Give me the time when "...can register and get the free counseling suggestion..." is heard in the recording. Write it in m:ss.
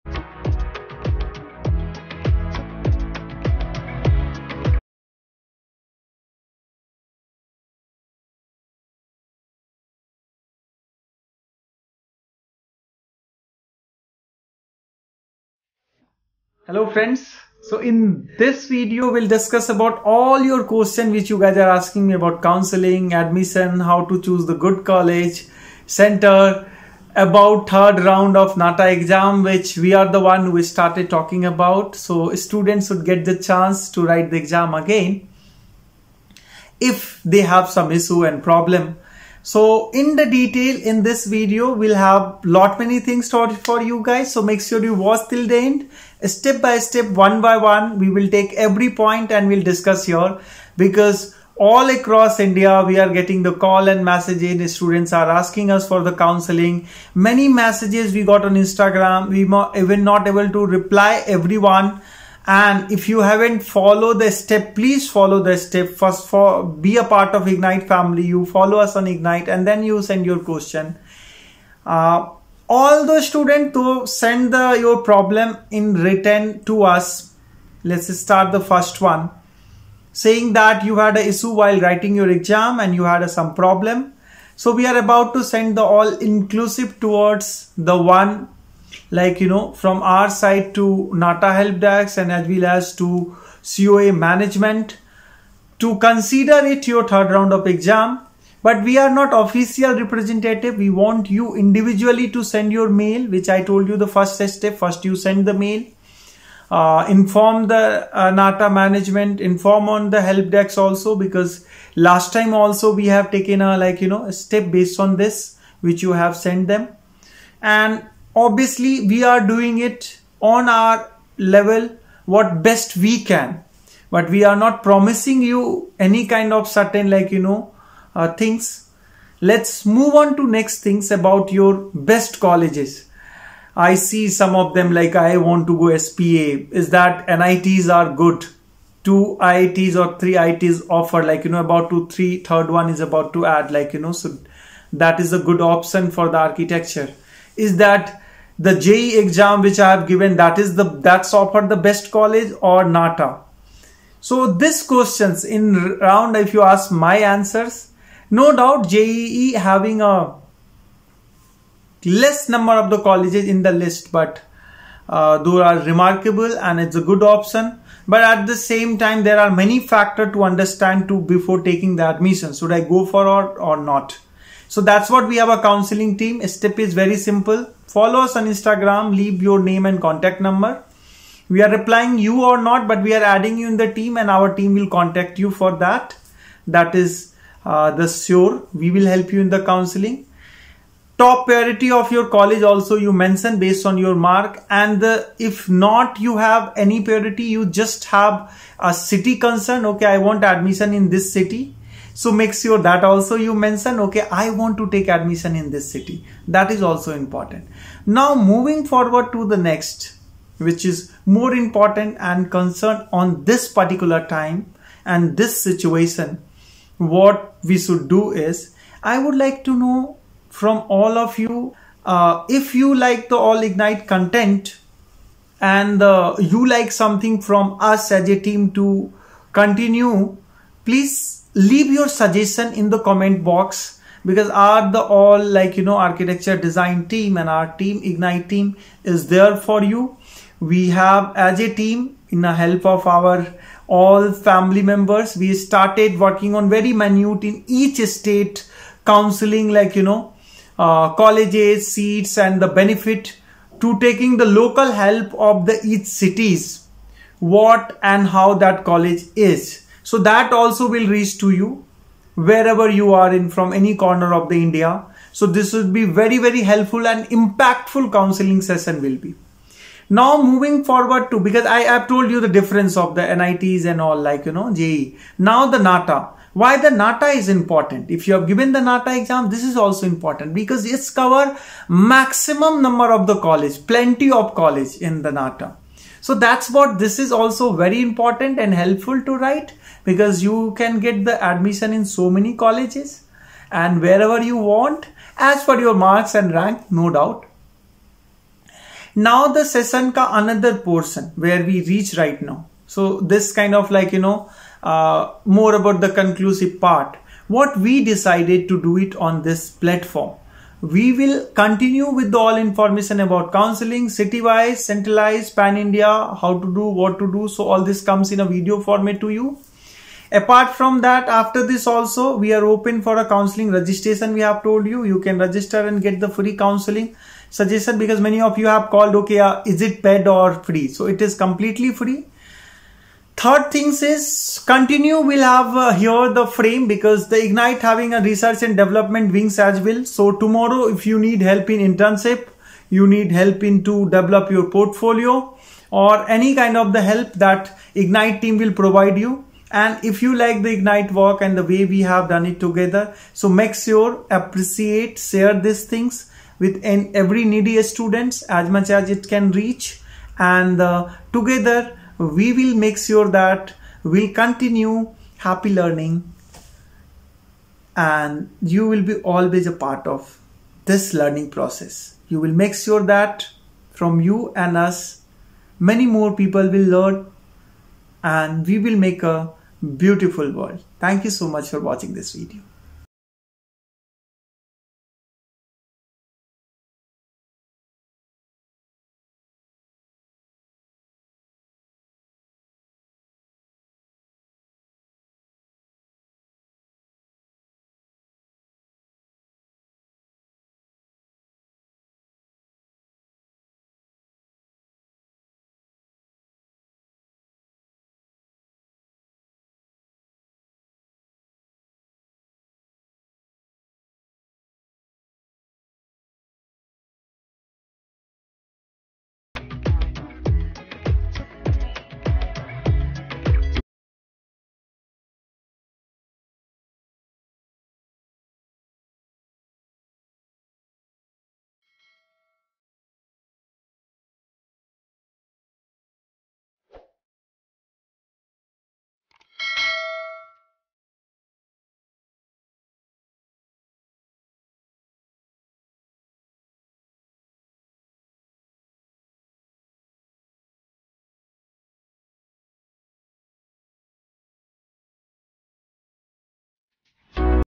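5:25.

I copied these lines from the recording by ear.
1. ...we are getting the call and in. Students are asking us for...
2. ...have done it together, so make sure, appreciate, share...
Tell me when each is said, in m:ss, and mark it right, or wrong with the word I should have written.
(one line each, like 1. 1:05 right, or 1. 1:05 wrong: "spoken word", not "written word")
1. 0:52 right
2. 5:52 right.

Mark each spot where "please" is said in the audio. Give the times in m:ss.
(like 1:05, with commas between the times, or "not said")
1:04, 3:50.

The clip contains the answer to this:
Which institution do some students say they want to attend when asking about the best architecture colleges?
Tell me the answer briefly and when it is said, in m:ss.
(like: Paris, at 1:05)
SPA, at 2:15.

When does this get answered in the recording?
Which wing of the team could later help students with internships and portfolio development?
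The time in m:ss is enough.
5:38.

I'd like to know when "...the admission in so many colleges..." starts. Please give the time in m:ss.
4:51.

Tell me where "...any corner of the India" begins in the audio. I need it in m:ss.
4:23.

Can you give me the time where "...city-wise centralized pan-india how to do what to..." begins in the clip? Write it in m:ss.
5:14.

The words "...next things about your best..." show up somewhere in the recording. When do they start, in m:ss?
2:10.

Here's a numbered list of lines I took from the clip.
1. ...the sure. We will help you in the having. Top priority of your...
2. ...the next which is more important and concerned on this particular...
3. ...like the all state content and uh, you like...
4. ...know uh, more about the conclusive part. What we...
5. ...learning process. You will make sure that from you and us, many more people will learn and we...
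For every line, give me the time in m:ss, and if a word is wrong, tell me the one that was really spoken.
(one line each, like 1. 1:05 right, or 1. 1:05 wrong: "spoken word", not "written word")
1. 3:07 wrong: "counseling", not "having"
2. 3:29 right
3. 3:42 wrong: "ignite", not "state"
4. 5:04 right
5. 6:11 right.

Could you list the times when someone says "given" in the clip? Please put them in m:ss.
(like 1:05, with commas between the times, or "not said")
2:30, 4:38.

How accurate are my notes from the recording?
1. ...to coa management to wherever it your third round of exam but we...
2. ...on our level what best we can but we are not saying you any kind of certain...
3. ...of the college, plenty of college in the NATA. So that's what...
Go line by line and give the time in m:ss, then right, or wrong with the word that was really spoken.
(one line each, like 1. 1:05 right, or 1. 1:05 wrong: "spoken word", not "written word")
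1. 1:32 wrong: "consider", not "wherever"
2. 2:00 wrong: "promising", not "saying"
3. 4:43 right.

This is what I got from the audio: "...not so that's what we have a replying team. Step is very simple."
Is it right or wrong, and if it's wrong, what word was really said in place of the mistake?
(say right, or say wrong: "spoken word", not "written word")
wrong: "counseling", not "replying".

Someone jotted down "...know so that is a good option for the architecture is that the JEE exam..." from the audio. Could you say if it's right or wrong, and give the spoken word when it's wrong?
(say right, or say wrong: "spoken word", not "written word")
right.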